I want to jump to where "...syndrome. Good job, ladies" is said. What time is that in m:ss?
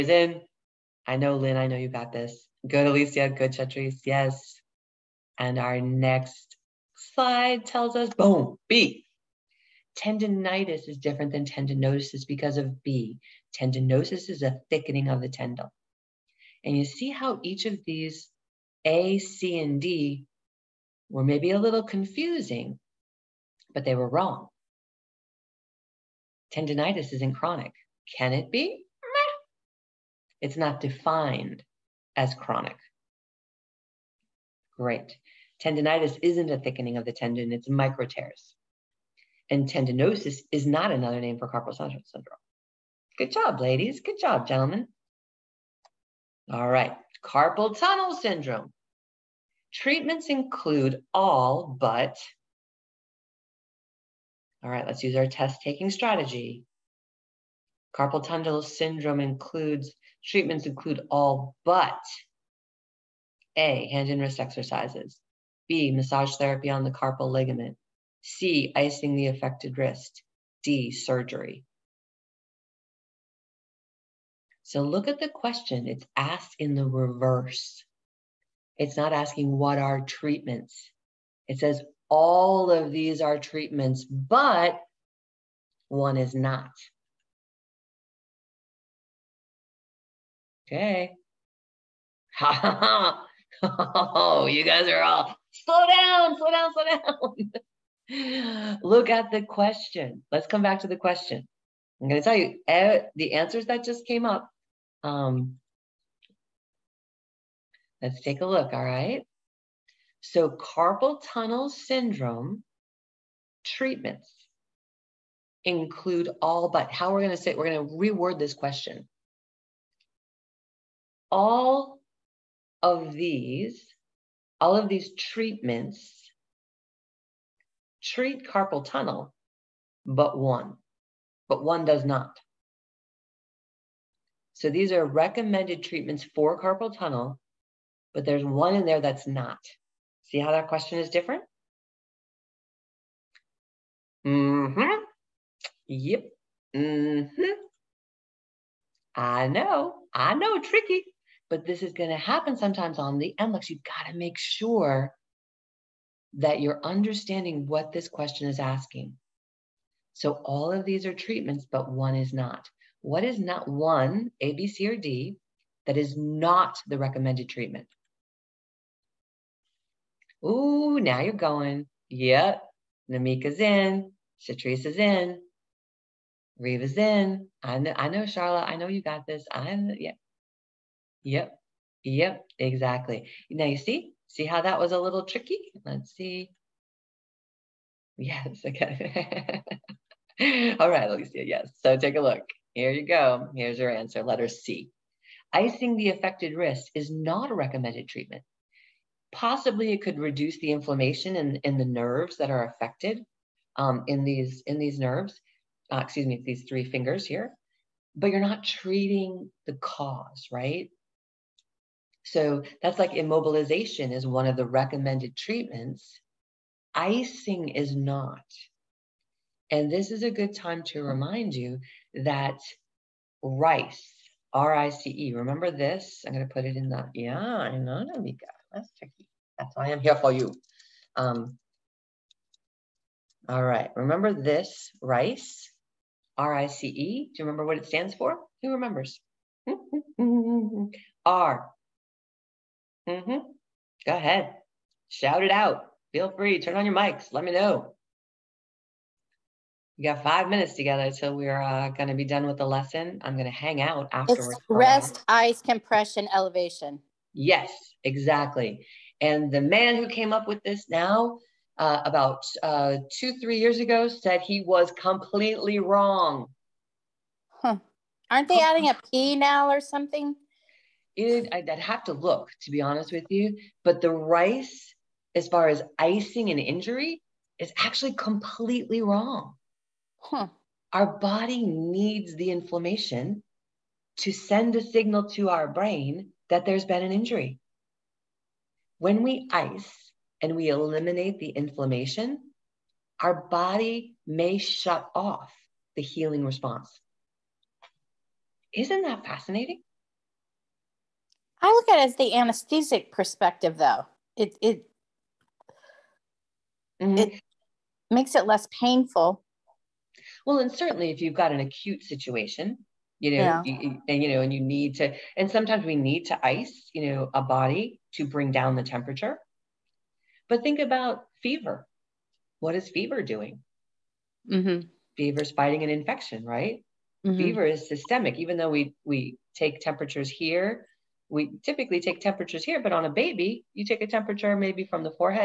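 0:42.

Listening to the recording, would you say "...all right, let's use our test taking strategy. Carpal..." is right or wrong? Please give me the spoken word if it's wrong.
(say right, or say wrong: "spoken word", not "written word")
right.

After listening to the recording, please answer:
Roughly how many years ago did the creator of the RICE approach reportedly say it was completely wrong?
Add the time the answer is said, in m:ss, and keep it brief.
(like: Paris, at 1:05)
2 or 3 years, at 4:23.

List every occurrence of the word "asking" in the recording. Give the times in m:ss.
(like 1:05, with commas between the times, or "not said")
1:19, 2:38.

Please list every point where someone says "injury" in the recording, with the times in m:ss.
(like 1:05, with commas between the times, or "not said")
4:36, 4:47.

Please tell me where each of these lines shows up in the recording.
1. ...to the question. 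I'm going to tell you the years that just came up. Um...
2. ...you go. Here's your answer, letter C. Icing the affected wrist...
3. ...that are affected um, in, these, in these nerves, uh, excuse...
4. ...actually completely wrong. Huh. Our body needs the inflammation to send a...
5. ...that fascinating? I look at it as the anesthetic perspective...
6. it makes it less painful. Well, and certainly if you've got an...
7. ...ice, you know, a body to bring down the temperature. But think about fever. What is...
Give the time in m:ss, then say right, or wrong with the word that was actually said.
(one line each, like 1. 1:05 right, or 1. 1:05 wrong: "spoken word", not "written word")
1. 1:40 wrong: "answers", not "years"
2. 3:12 right
3. 3:22 right
4. 4:37 right
5. 4:59 right
6. 5:07 right
7. 5:16 right.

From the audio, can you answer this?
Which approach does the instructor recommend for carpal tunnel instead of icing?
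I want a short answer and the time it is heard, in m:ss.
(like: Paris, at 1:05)
immobilization, at 3:33.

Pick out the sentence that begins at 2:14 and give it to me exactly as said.
So these are recommended treatments for carpal tunnel, but there's one in there that's not.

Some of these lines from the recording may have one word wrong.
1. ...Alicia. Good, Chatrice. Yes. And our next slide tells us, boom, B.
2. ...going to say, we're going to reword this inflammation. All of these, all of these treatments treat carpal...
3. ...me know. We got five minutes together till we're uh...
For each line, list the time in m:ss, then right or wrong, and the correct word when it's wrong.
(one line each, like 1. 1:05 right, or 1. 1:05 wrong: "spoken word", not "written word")
1. 0:02 right
2. 1:57 wrong: "question", not "inflammation"
3. 4:07 right.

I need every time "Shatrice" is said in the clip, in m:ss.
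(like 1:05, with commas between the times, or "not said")
2:54.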